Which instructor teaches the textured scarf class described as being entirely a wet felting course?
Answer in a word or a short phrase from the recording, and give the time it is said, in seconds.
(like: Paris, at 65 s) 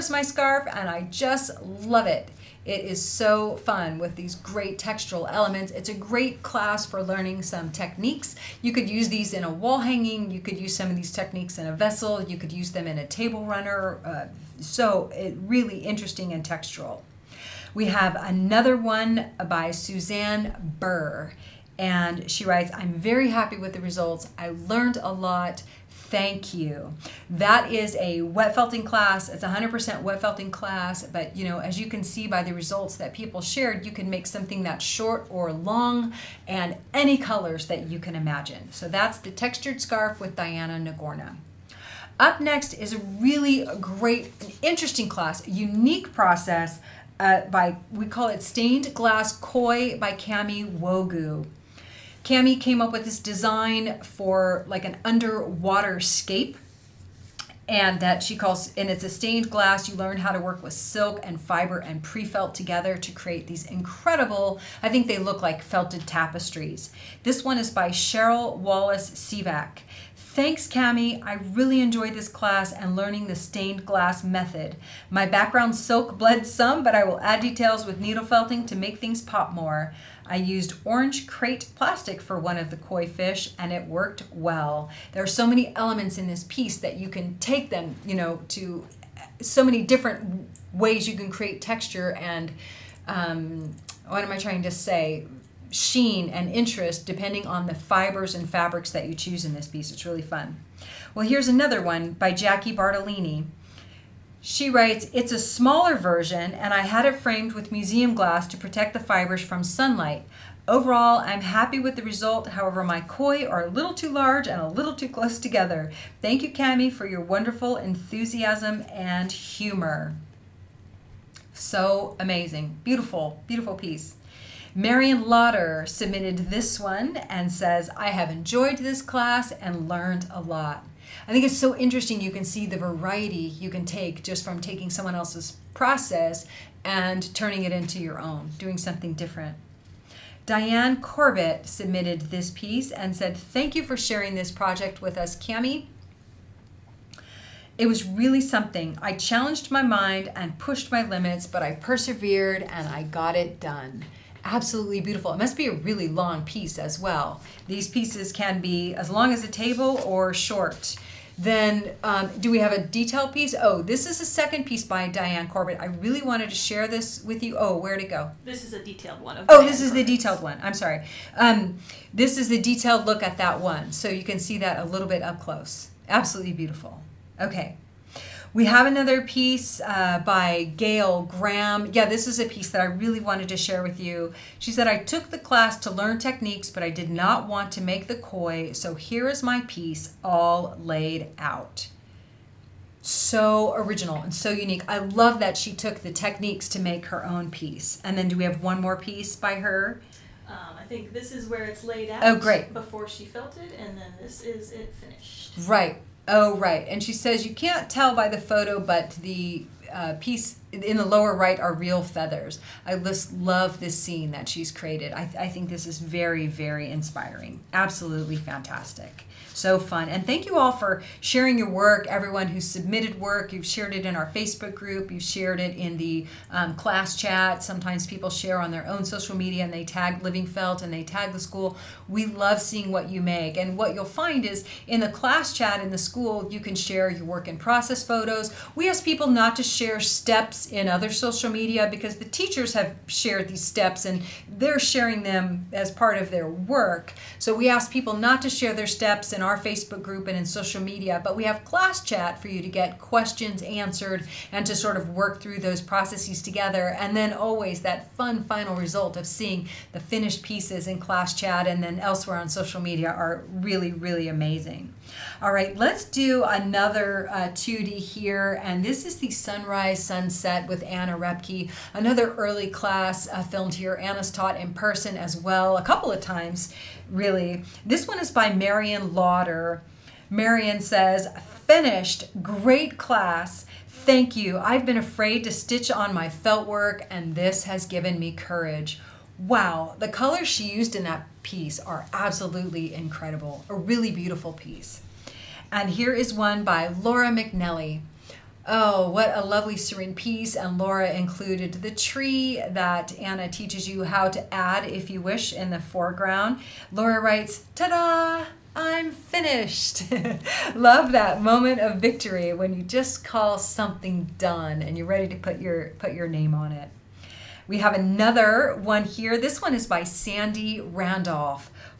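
Diana Nagorna, at 40 s.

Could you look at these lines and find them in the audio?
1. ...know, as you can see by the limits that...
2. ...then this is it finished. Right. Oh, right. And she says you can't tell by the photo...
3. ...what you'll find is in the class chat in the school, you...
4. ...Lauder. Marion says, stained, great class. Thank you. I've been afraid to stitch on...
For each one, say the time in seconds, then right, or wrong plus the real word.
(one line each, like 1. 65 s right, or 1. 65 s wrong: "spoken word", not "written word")
1. 31 s wrong: "results", not "limits"
2. 203 s right
3. 233 s right
4. 279 s wrong: "finished", not "stained".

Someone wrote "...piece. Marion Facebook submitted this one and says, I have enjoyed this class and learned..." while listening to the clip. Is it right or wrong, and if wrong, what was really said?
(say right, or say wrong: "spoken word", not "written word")
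wrong: "Lauder", not "Facebook".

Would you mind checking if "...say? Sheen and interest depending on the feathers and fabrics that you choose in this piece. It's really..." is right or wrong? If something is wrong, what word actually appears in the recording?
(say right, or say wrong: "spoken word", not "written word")
wrong: "fibers", not "feathers".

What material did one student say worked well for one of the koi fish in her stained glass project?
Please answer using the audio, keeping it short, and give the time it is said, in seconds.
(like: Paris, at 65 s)
orange crate plastic, at 80 s.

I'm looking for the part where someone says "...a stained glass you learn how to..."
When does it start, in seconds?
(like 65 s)
59 s.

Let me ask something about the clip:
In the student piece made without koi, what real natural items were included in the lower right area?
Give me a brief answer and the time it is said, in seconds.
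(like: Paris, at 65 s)
feathers, at 212 s.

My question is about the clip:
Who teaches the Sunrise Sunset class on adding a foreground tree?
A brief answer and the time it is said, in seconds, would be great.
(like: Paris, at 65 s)
Anna Repke, at 270 s.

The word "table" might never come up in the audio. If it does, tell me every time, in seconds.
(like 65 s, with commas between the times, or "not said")
13 s, 159 s.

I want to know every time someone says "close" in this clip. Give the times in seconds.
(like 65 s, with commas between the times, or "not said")
115 s, 175 s.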